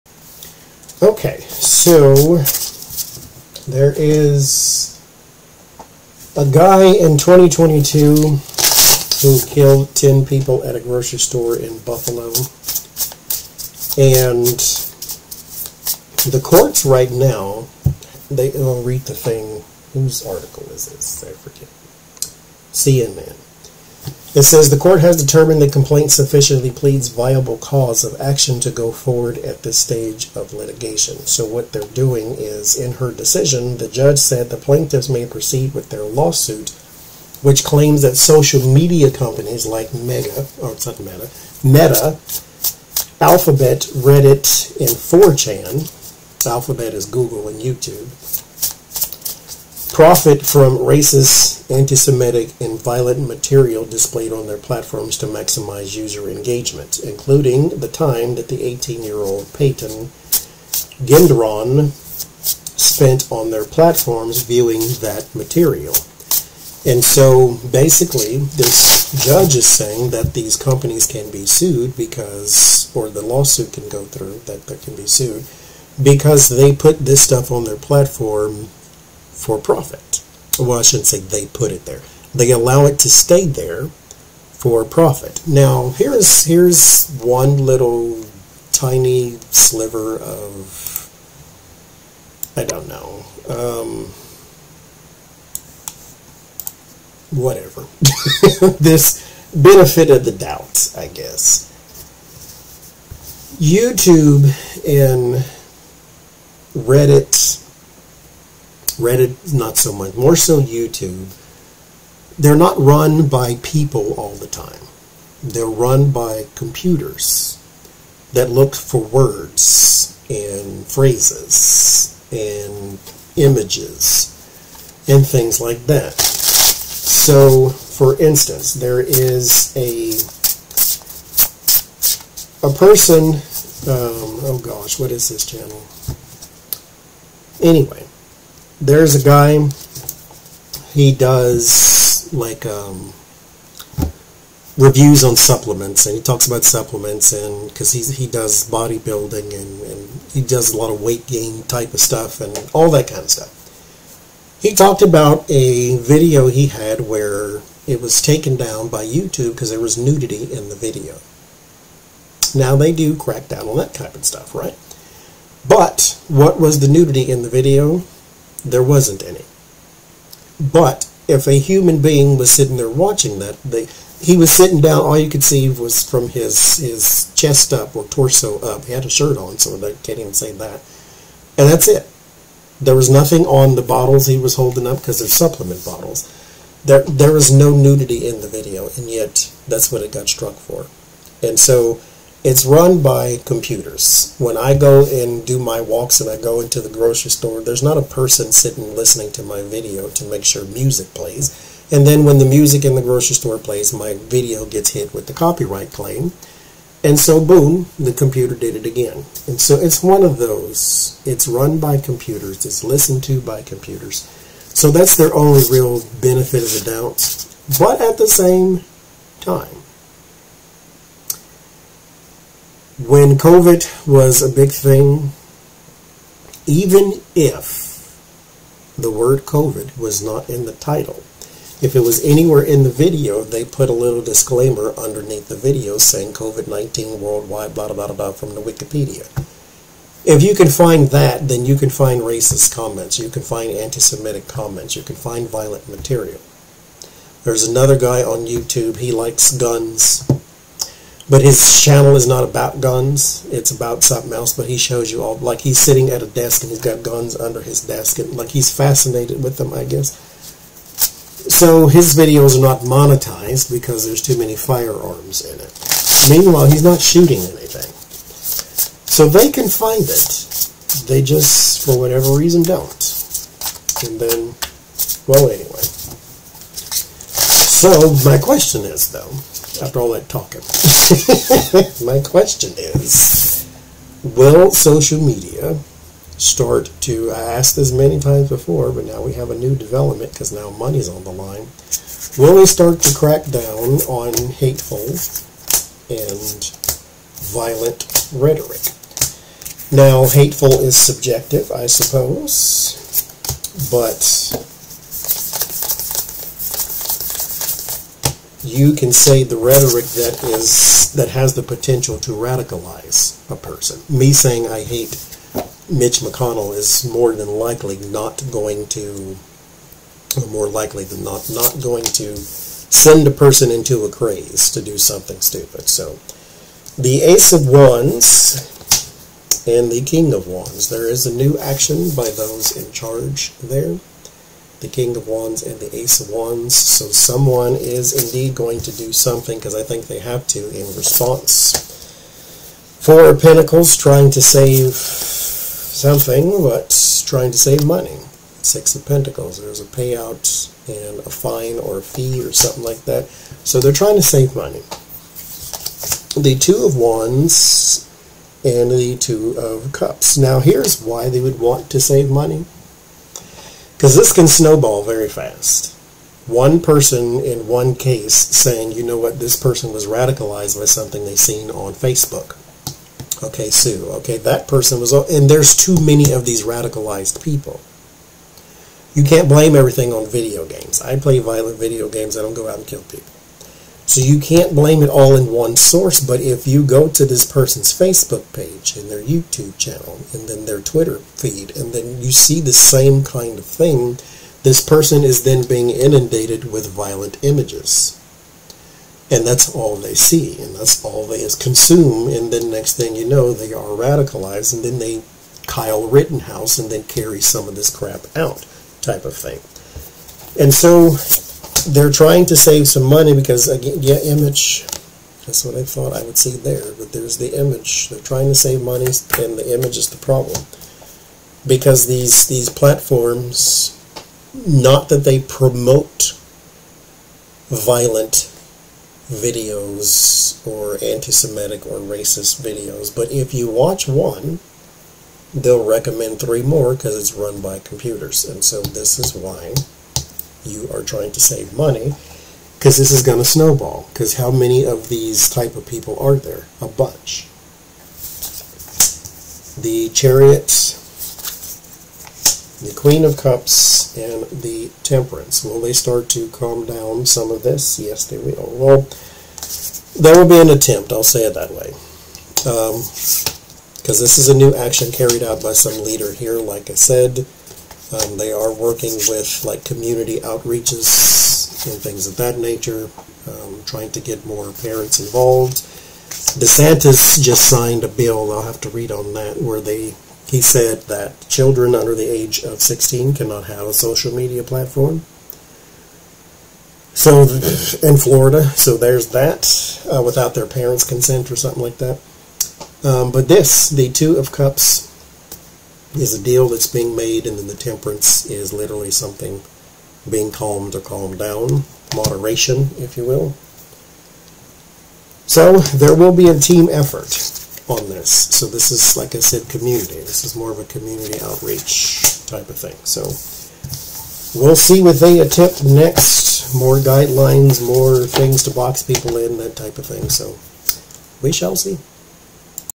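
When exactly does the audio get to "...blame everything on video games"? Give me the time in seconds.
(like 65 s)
379 s.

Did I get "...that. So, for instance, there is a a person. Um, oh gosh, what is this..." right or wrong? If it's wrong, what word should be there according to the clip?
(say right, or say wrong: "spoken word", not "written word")
right.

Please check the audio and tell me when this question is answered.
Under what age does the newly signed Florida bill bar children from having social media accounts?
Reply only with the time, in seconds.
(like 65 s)
482 s.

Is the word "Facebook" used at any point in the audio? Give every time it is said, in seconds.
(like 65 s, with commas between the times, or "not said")
371 s, 387 s.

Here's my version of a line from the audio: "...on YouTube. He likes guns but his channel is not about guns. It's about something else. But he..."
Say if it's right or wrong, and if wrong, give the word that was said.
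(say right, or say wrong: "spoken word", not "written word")
right.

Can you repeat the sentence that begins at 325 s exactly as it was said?
So, the Ace of Wands and the King of Wands.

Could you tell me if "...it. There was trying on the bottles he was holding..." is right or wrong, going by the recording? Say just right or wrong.
wrong.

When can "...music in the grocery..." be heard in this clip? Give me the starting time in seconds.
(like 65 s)
202 s.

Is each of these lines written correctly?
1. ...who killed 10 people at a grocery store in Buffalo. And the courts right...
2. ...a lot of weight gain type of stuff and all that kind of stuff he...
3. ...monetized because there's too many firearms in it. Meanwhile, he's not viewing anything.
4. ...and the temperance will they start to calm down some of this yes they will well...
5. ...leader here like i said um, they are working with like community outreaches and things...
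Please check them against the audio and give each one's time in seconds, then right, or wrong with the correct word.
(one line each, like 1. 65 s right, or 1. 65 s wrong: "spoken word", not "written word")
1. 9 s right
2. 150 s right
3. 262 s wrong: "shooting", not "viewing"
4. 454 s right
5. 466 s right.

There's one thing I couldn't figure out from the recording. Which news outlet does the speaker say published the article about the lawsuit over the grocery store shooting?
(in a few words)
CNN.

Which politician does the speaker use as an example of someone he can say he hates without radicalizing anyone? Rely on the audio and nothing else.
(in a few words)
Mitch McConnell.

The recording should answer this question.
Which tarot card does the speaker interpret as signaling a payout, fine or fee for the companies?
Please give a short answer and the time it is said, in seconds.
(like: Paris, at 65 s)
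Six of Pentacles, at 348 s.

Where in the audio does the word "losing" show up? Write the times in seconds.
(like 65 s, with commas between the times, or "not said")
not said.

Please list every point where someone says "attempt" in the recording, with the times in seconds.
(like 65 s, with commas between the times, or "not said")
460 s, 515 s.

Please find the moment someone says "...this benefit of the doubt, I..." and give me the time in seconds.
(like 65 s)
98 s.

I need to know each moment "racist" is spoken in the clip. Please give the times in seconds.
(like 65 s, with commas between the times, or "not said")
50 s, 242 s, 431 s.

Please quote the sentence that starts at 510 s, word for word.
This is more of a community outreach type of thing.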